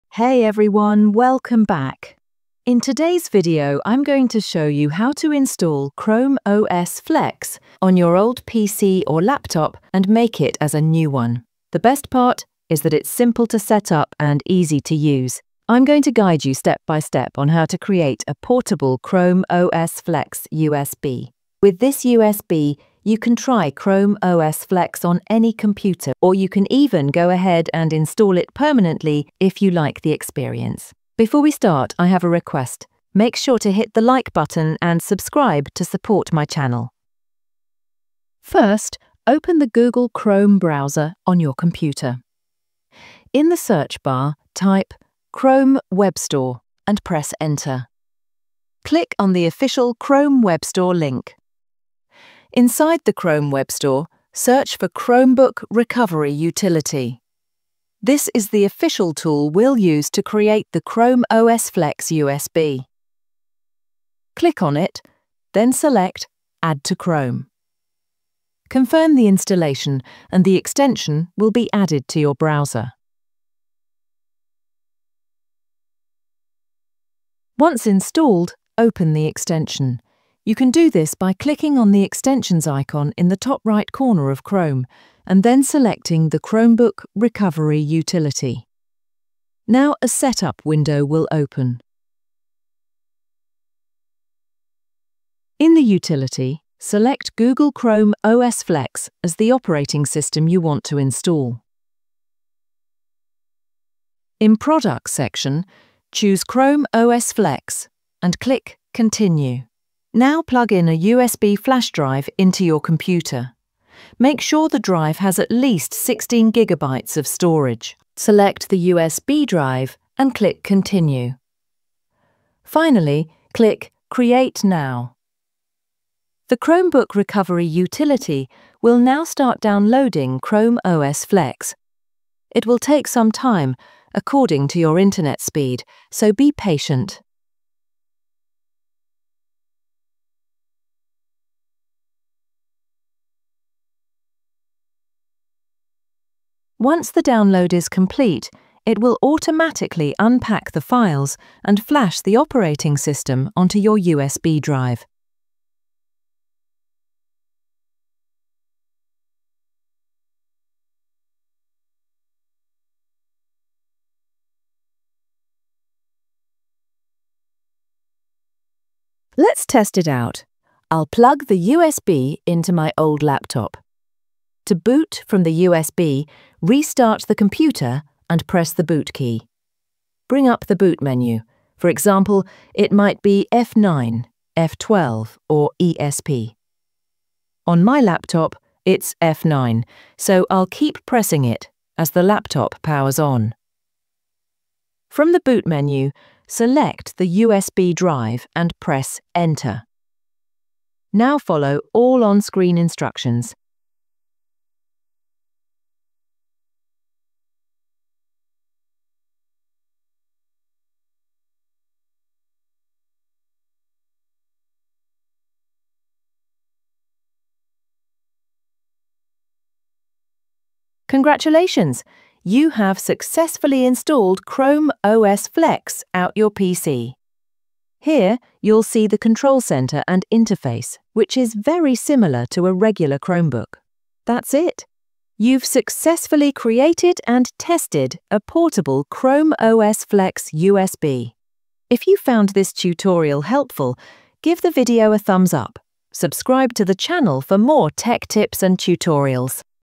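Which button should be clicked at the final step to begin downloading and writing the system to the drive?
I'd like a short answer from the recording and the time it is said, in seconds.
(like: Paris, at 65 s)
Create Now, at 124 s.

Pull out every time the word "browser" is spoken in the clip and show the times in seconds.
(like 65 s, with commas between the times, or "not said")
40 s, 72 s.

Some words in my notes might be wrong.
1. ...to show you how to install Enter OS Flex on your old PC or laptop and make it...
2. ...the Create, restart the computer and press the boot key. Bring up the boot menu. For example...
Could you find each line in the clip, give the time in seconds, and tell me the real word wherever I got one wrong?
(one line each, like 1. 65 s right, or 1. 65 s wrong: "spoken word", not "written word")
1. 4 s wrong: "Chrome", not "Enter"
2. 175 s wrong: "USB", not "Create".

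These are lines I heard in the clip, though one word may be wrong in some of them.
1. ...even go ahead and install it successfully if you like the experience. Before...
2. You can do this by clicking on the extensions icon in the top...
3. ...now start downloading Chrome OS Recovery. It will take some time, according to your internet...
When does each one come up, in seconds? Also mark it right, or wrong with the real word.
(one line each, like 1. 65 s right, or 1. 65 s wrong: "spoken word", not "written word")
1. 26 s wrong: "permanently", not "successfully"
2. 80 s right
3. 128 s wrong: "Flex", not "Recovery".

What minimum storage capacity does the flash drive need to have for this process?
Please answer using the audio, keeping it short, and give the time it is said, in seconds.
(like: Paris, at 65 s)
16 gigabytes, at 115 s.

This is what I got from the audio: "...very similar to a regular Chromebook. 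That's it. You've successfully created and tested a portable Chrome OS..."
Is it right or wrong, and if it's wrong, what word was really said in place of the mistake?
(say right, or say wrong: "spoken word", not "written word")
right.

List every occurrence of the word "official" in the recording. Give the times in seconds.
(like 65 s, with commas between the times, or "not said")
49 s, 58 s.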